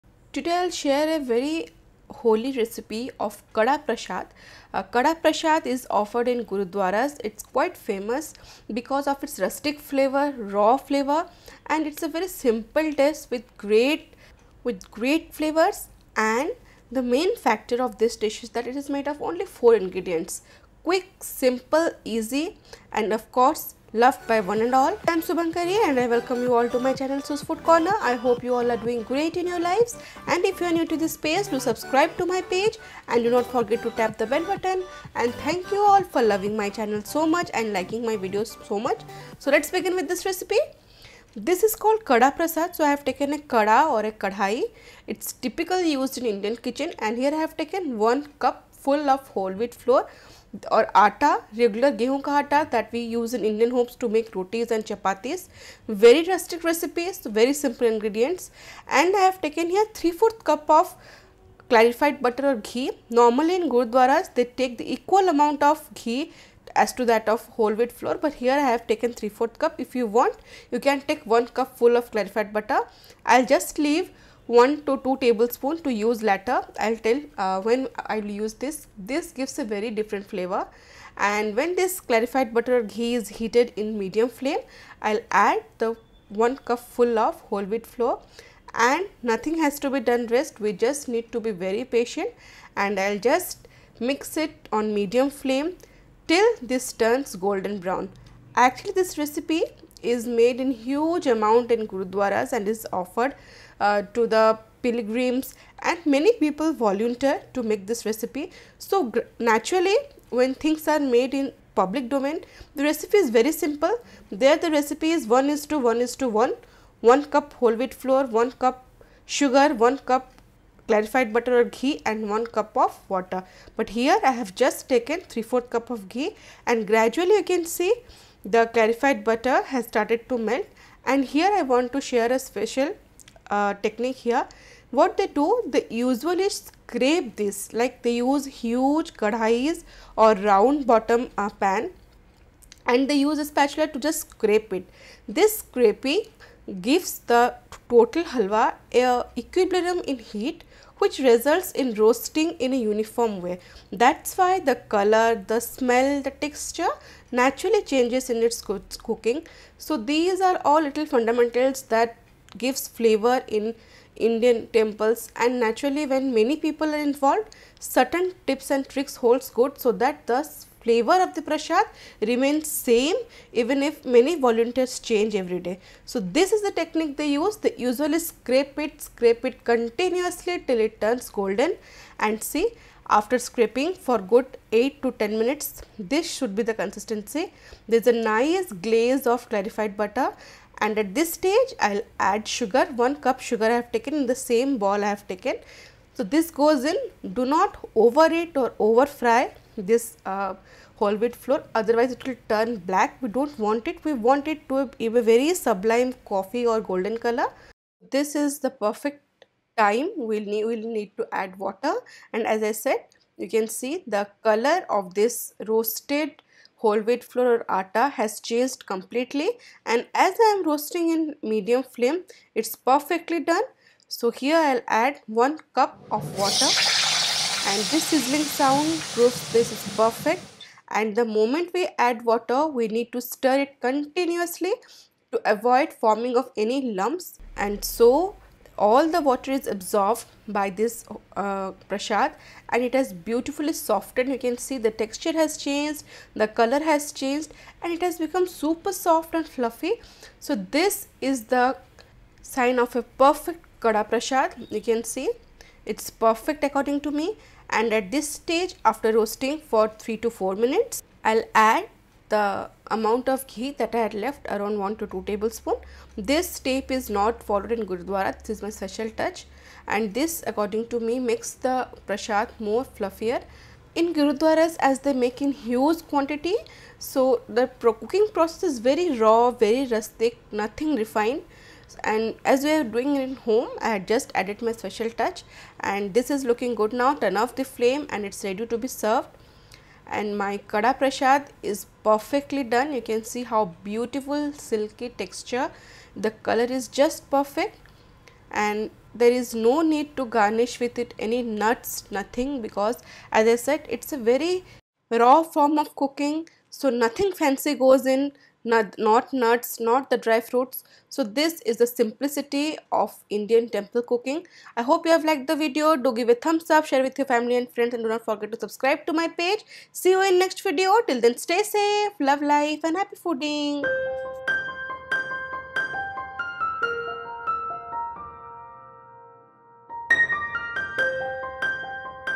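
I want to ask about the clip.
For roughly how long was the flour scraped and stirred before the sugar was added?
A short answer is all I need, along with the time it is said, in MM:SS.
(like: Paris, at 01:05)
8 to 10 minutes, at 03:04.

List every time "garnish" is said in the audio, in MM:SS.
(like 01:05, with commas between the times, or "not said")
05:00.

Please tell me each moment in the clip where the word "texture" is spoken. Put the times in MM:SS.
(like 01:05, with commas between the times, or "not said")
02:36, 04:05, 04:55.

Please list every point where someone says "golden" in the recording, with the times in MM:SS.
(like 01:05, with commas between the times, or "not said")
01:37, 03:01, 03:26.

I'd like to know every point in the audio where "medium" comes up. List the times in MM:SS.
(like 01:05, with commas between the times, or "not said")
01:23, 01:34, 03:41.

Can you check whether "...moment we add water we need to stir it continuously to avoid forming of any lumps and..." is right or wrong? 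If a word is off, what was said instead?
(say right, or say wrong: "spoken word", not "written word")
right.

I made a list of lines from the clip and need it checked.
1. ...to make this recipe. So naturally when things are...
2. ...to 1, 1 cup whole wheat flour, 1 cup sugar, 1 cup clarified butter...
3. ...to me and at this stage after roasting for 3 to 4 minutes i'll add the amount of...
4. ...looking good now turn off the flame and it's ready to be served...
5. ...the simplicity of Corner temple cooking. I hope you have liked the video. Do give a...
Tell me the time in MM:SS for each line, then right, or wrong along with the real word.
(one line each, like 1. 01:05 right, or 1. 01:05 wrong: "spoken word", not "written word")
1. 01:47 right
2. 01:56 right
3. 04:17 right
4. 04:46 right
5. 05:11 wrong: "Indian", not "Corner".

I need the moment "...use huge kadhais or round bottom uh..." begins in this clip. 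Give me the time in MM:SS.
02:18.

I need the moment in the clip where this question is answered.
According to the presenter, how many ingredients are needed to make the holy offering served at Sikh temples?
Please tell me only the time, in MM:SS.
00:19.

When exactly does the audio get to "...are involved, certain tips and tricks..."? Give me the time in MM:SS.
02:46.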